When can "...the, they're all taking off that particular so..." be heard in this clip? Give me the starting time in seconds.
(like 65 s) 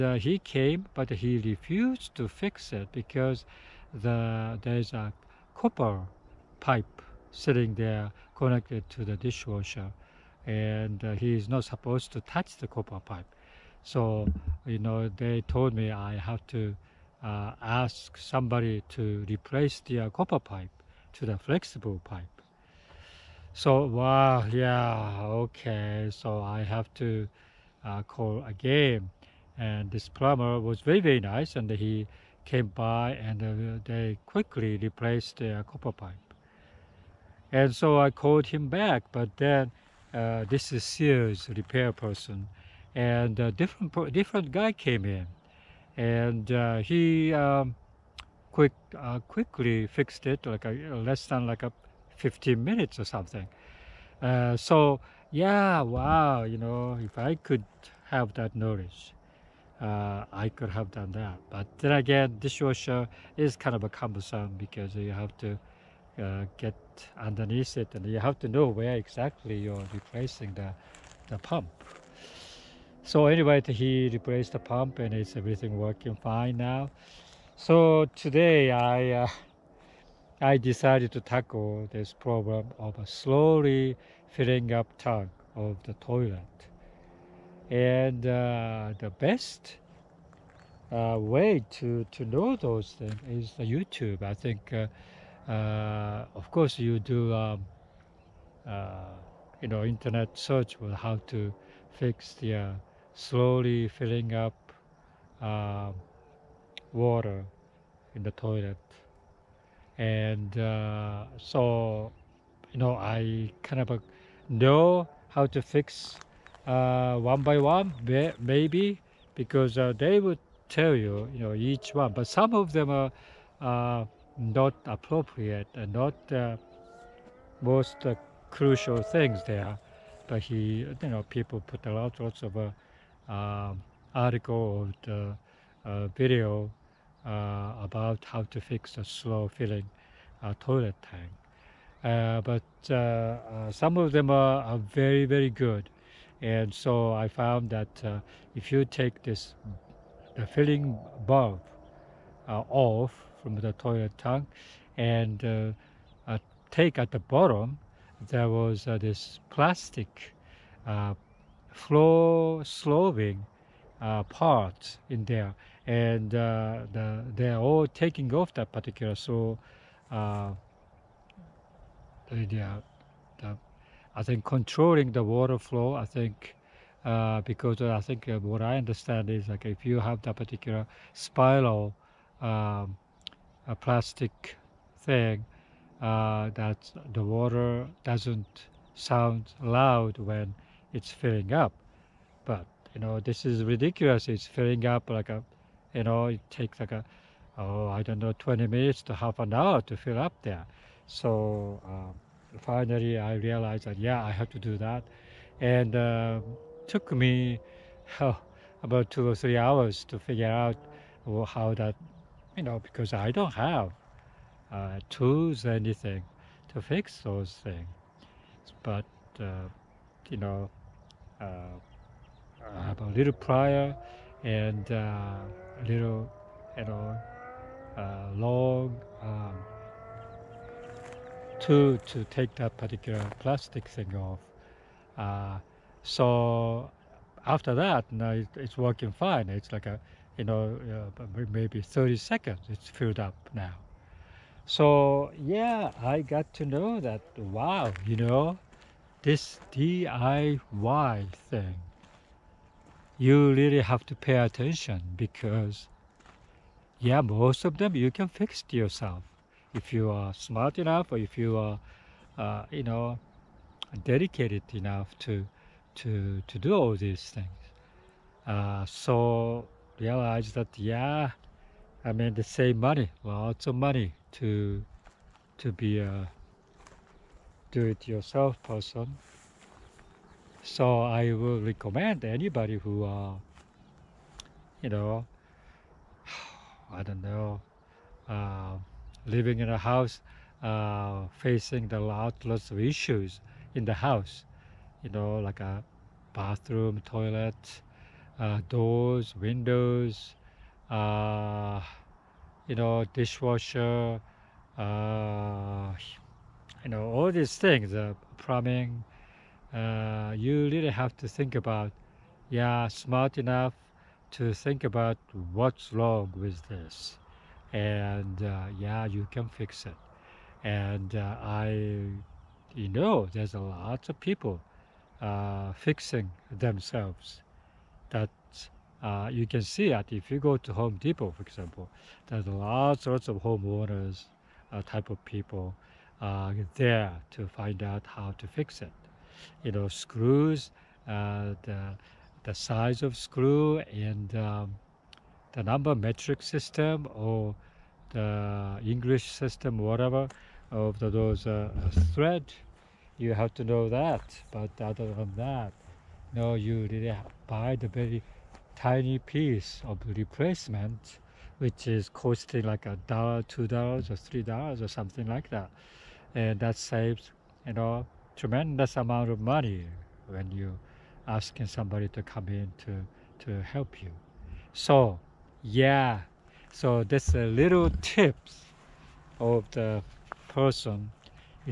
166 s.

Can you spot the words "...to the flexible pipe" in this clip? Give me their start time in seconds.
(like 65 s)
21 s.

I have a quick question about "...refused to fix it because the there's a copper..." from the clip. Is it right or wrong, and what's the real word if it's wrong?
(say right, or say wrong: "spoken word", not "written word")
right.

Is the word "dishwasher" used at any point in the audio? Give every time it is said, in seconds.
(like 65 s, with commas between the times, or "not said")
9 s, 62 s, 303 s.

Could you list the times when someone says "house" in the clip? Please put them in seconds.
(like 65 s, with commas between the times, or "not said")
289 s, 293 s.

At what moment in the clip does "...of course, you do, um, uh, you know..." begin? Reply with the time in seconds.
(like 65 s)
96 s.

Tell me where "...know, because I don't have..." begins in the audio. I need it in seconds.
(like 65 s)
212 s.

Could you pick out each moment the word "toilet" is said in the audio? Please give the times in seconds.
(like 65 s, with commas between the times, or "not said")
85 s, 108 s, 140 s, 153 s, 297 s.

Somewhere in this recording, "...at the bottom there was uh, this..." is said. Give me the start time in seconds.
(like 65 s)
156 s.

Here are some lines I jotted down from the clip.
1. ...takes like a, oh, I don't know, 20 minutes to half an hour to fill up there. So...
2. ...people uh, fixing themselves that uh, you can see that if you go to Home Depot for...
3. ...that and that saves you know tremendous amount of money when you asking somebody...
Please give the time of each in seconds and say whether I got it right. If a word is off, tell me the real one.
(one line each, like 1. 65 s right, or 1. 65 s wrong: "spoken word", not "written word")
1. 196 s right
2. 324 s right
3. 365 s right.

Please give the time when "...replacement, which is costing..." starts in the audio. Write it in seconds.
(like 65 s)
360 s.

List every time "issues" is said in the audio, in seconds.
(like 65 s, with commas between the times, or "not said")
292 s.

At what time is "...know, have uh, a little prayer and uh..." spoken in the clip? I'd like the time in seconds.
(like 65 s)
220 s.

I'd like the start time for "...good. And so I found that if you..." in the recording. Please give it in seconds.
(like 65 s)
145 s.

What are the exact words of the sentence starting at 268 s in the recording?
Uh, so realize that, yeah, I mean, the same money, lots of money to, to be a do-it-yourself person.